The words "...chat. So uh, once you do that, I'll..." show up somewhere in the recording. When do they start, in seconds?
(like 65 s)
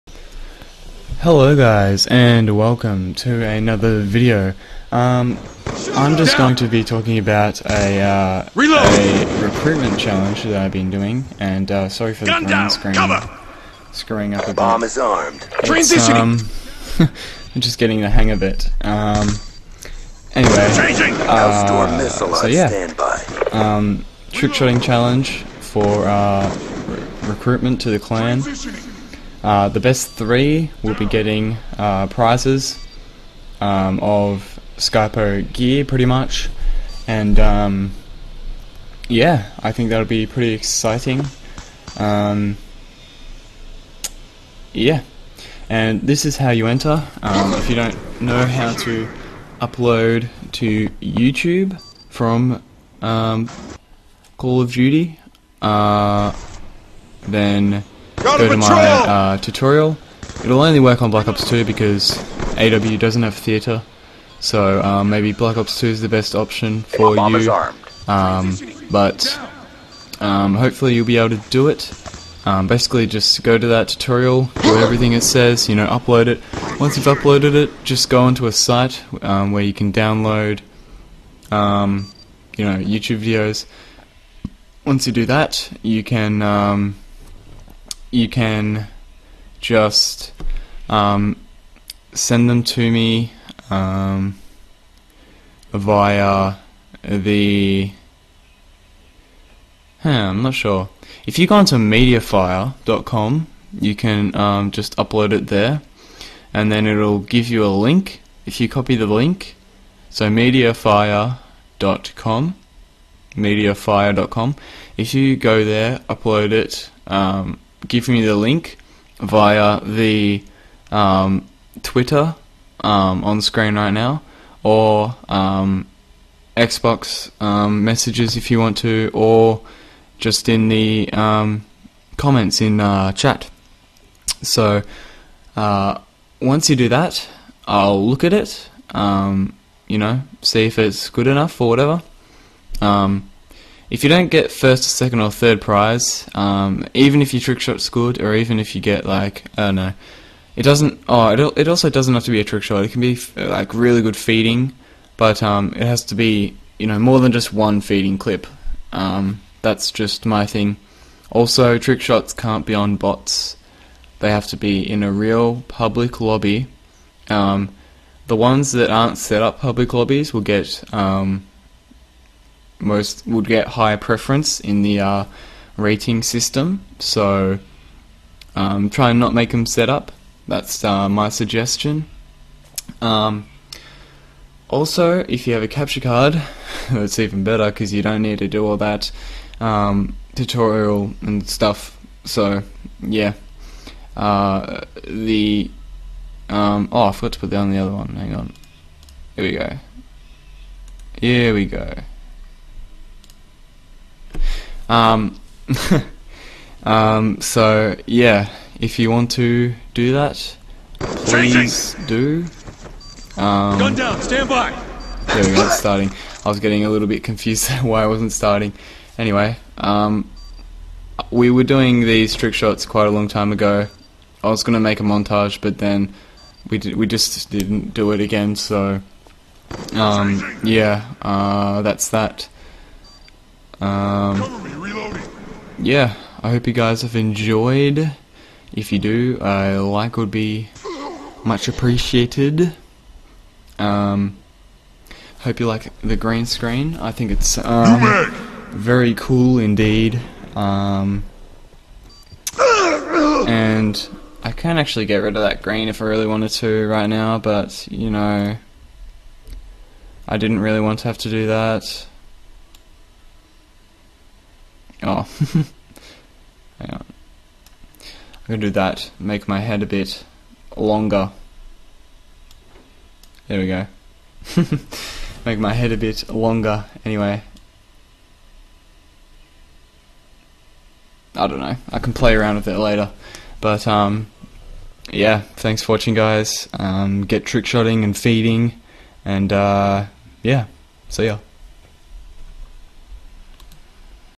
133 s.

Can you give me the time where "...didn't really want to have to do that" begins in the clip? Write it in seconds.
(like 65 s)
260 s.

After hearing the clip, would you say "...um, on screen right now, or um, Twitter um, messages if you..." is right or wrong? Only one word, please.
wrong.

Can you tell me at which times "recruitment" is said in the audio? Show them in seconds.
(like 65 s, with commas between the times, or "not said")
9 s, 27 s.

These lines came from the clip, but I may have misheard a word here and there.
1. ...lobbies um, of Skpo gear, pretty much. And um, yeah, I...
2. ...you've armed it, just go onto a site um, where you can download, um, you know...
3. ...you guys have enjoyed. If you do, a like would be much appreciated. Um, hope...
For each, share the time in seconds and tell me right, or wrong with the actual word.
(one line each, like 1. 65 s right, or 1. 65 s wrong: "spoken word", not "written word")
1. 32 s wrong: "prizes", not "lobbies"
2. 76 s wrong: "uploaded", not "armed"
3. 236 s right.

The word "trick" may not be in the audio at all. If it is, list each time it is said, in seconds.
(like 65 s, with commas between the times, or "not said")
24 s, 147 s, 152 s, 161 s, 222 s, 287 s.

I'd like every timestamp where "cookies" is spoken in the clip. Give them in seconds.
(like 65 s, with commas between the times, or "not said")
not said.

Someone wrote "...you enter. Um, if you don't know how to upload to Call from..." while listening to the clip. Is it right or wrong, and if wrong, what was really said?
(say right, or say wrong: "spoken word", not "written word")
wrong: "YouTube", not "Call".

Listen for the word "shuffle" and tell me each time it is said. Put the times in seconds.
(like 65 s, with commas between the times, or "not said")
not said.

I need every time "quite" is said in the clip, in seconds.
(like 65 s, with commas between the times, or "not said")
222 s.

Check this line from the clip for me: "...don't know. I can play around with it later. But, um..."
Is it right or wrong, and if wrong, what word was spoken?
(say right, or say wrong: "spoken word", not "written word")
right.